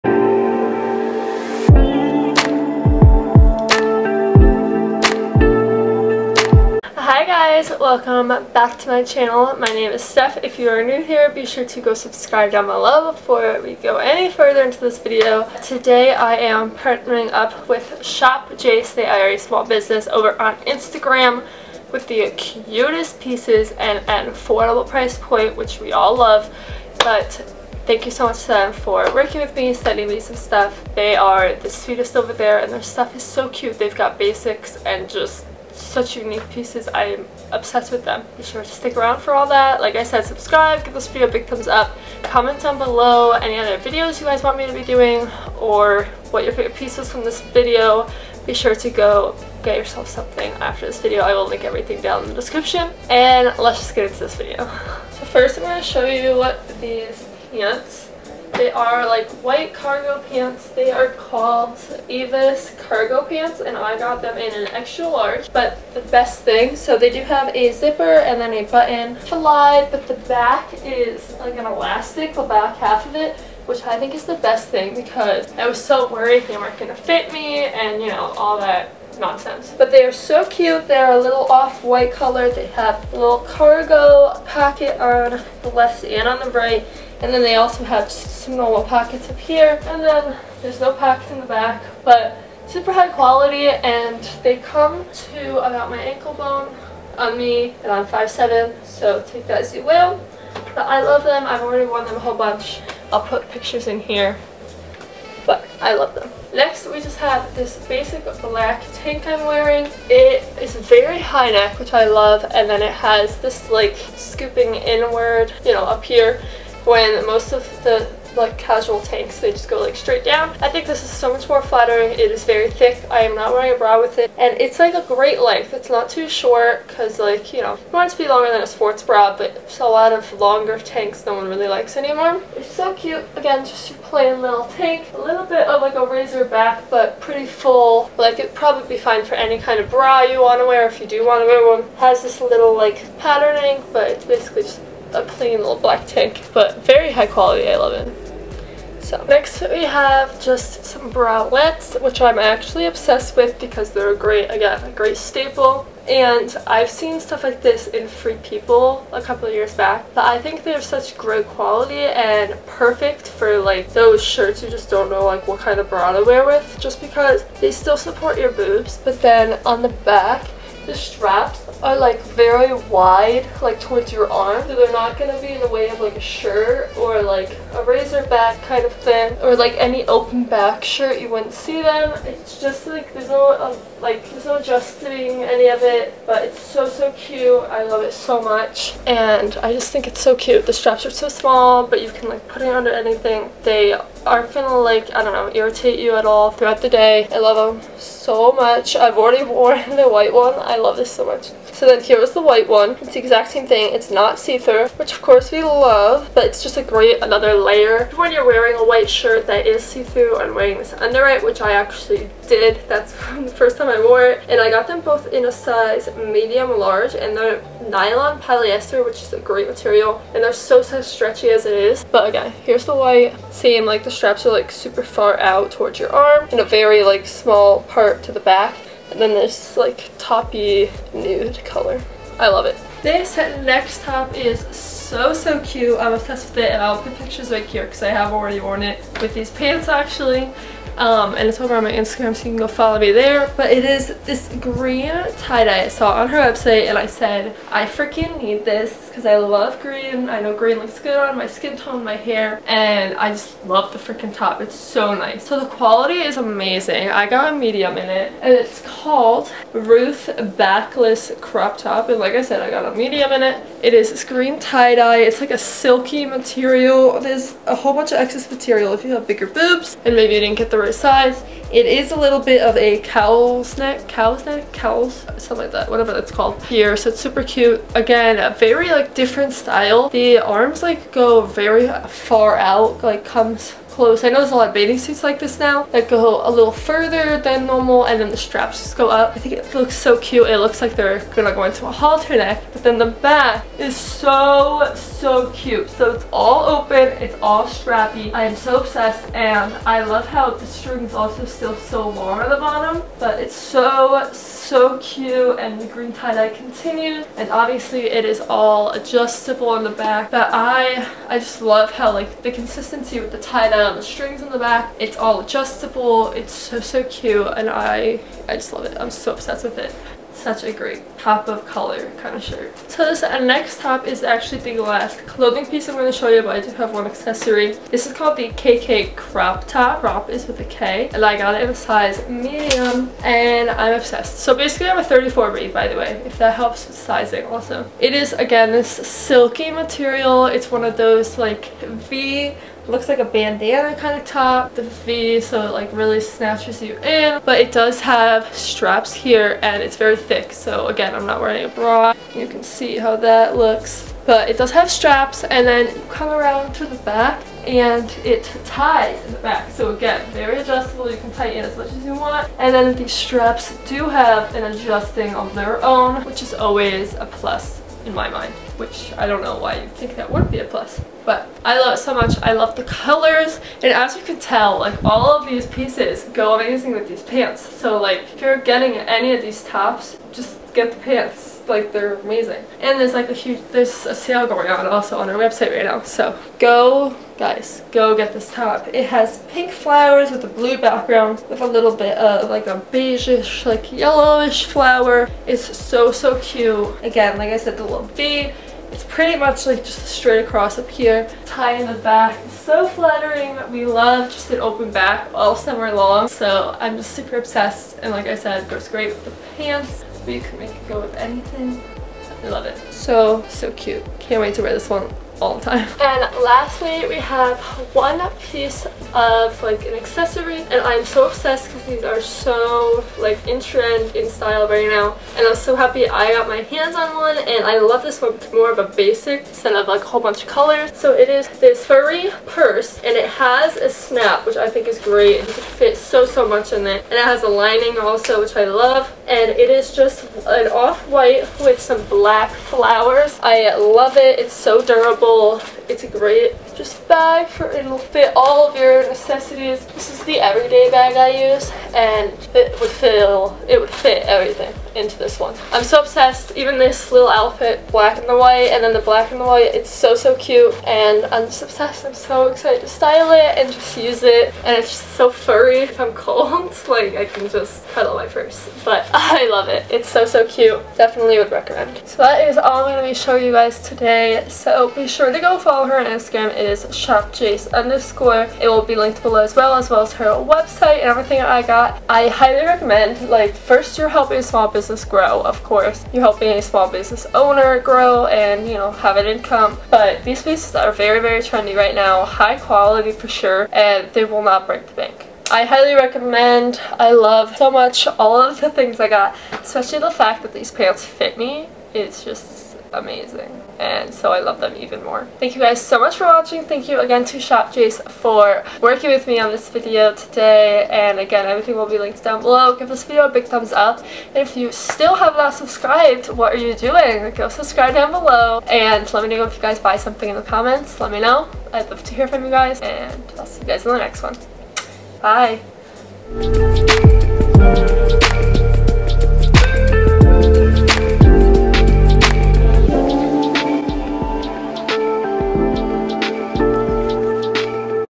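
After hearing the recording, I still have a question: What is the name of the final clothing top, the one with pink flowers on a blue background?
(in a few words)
KK crop top.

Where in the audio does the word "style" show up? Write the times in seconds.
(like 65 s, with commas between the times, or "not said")
279 s, 424 s, 462 s.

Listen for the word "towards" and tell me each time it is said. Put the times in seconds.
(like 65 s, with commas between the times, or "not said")
173 s, 225 s.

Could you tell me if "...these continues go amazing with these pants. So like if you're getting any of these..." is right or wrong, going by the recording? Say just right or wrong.
wrong.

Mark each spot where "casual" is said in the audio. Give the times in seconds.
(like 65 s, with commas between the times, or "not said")
118 s.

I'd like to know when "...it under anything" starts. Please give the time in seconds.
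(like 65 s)
192 s.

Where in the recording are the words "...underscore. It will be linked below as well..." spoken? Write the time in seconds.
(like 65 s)
477 s.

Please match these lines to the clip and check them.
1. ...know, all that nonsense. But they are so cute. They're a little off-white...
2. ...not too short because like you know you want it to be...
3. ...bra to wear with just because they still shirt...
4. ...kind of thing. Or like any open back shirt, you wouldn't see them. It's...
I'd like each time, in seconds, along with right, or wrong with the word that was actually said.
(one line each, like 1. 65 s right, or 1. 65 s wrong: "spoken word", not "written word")
1. 78 s right
2. 125 s right
3. 165 s wrong: "support", not "shirt"
4. 178 s right.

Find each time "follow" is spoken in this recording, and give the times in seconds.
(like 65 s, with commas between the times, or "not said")
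242 s, 475 s.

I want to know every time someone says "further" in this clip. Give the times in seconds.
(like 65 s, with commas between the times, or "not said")
14 s, 286 s.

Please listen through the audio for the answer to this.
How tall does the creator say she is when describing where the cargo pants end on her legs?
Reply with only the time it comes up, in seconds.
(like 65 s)
98 s.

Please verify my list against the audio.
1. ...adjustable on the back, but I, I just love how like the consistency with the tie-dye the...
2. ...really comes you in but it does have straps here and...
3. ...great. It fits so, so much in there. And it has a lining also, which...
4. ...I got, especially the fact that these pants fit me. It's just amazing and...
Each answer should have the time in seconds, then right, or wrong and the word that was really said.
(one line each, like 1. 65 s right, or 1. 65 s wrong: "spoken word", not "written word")
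1. 308 s right
2. 345 s wrong: "snatches", not "comes"
3. 434 s right
4. 499 s right.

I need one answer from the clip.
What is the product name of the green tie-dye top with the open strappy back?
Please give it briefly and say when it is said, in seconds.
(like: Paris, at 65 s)
Ruth Backless Crop Top, at 259 s.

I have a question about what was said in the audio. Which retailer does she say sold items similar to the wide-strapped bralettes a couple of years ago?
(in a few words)
Free People.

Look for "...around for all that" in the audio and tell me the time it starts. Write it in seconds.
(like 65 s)
38 s.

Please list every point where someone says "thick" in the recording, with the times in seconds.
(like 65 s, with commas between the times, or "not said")
122 s, 350 s.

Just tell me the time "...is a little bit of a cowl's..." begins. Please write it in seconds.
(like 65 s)
271 s.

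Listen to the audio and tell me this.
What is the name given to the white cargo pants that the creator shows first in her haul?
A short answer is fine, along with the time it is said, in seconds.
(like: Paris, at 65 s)
Evis cargo pants, at 62 s.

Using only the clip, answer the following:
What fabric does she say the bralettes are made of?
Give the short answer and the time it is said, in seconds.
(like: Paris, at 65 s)
Nylon polyester, at 217 s.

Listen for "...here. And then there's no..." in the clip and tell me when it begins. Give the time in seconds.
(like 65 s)
89 s.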